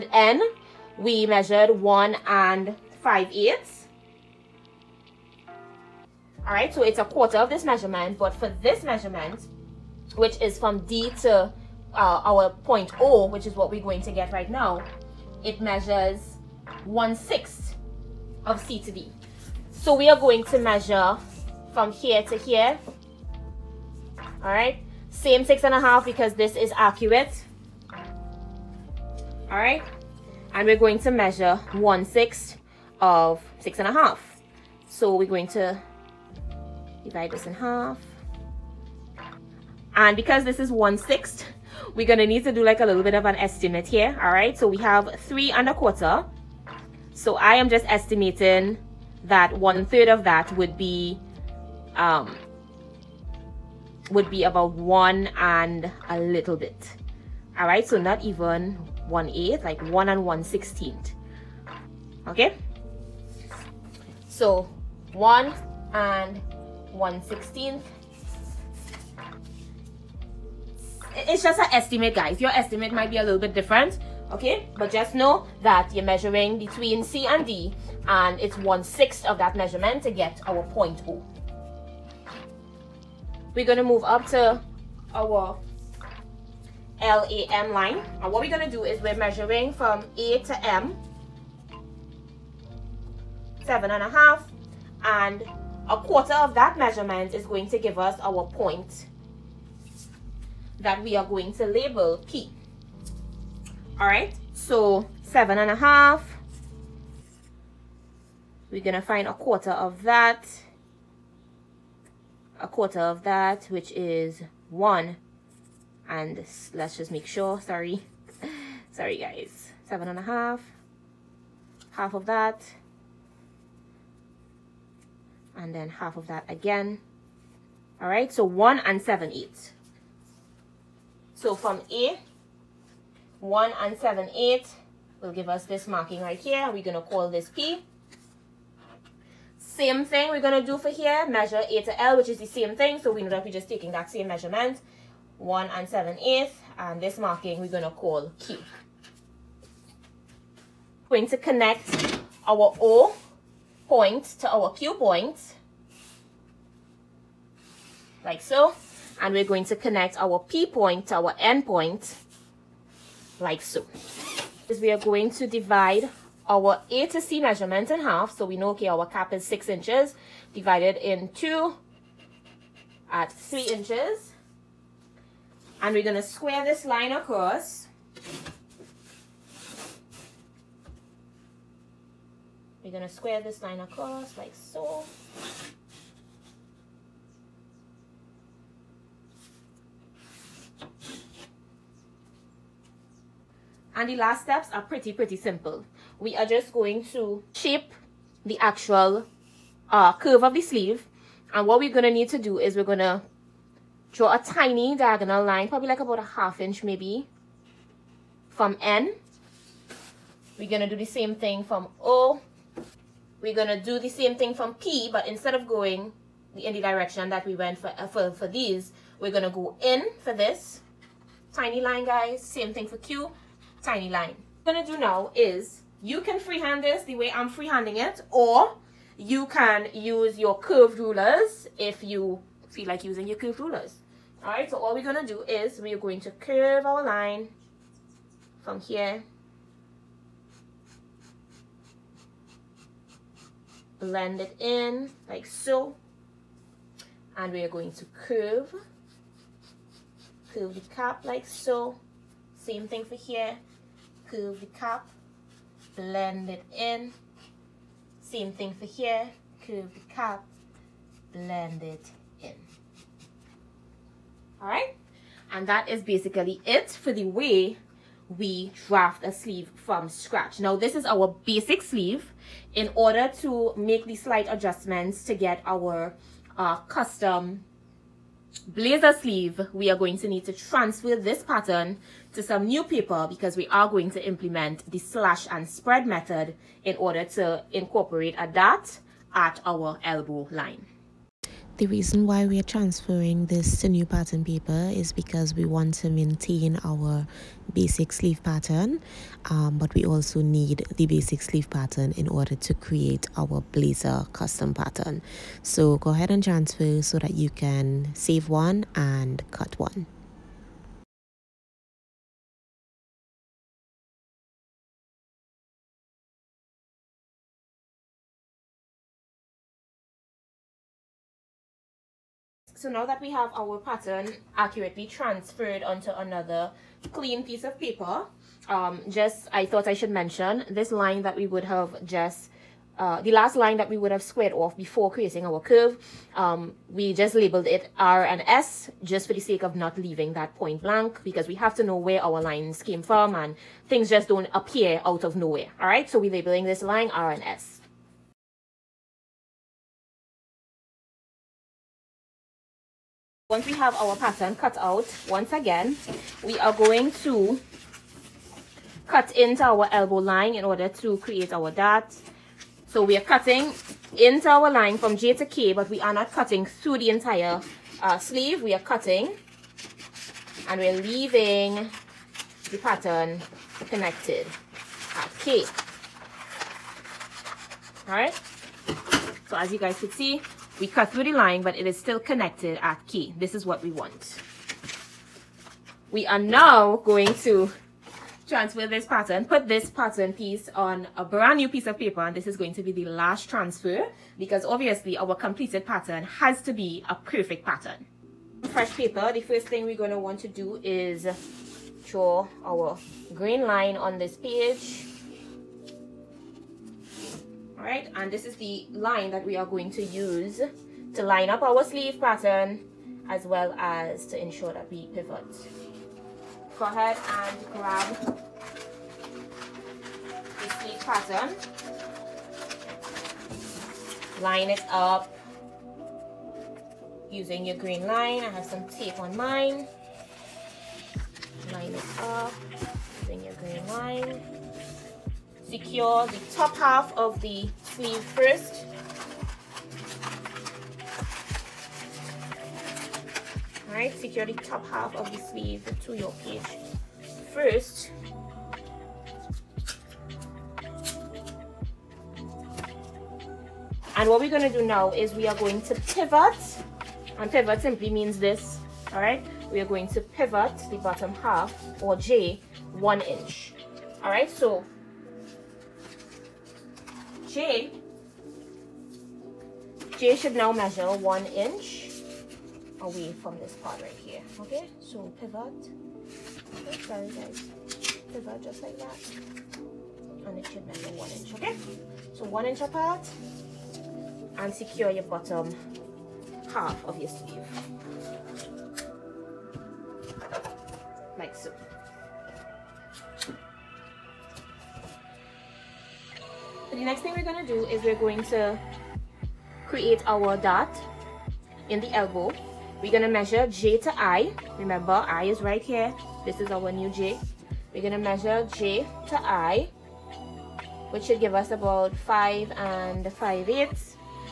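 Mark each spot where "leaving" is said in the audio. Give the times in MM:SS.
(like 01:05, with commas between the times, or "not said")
05:39, 06:11.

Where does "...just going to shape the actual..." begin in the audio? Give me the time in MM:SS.
03:16.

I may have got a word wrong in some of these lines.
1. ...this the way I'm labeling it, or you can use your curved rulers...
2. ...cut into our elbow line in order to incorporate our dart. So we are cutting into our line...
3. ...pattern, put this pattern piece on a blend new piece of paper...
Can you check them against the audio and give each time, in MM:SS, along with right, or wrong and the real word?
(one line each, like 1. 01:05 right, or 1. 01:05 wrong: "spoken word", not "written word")
1. 03:46 wrong: "freehanding", not "labeling"
2. 05:59 wrong: "create", not "incorporate"
3. 06:29 wrong: "brand", not "blend".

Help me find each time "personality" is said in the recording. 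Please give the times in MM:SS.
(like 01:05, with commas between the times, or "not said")
not said.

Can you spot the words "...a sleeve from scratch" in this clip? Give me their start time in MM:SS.
04:29.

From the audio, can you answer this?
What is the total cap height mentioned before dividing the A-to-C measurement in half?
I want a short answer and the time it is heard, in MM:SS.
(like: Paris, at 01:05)
six inches, at 02:49.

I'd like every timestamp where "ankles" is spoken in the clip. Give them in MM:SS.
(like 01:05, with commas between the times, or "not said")
not said.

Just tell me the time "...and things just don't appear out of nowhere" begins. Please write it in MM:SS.
05:43.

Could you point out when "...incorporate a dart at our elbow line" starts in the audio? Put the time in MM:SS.
04:47.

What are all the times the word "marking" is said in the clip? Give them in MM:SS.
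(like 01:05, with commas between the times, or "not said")
02:15, 02:27.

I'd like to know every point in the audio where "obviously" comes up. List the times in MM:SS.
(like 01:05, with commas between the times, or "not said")
06:34.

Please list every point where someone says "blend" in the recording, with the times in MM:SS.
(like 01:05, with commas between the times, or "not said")
04:04, 04:15, 04:21.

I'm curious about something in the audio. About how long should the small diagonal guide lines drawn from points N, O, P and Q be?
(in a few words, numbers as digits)
about a half inch.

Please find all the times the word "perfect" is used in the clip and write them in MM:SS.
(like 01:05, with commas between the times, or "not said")
06:37.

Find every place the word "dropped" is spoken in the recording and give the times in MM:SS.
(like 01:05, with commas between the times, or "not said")
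not said.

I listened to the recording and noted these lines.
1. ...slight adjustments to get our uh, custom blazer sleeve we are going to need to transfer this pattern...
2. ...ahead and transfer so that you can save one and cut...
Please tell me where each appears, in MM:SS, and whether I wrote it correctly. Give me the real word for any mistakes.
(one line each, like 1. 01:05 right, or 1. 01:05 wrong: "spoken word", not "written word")
1. 04:34 right
2. 05:06 right.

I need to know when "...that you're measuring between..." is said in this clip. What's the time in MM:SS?
01:15.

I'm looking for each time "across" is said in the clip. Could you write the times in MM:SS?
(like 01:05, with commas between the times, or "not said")
02:57, 03:03.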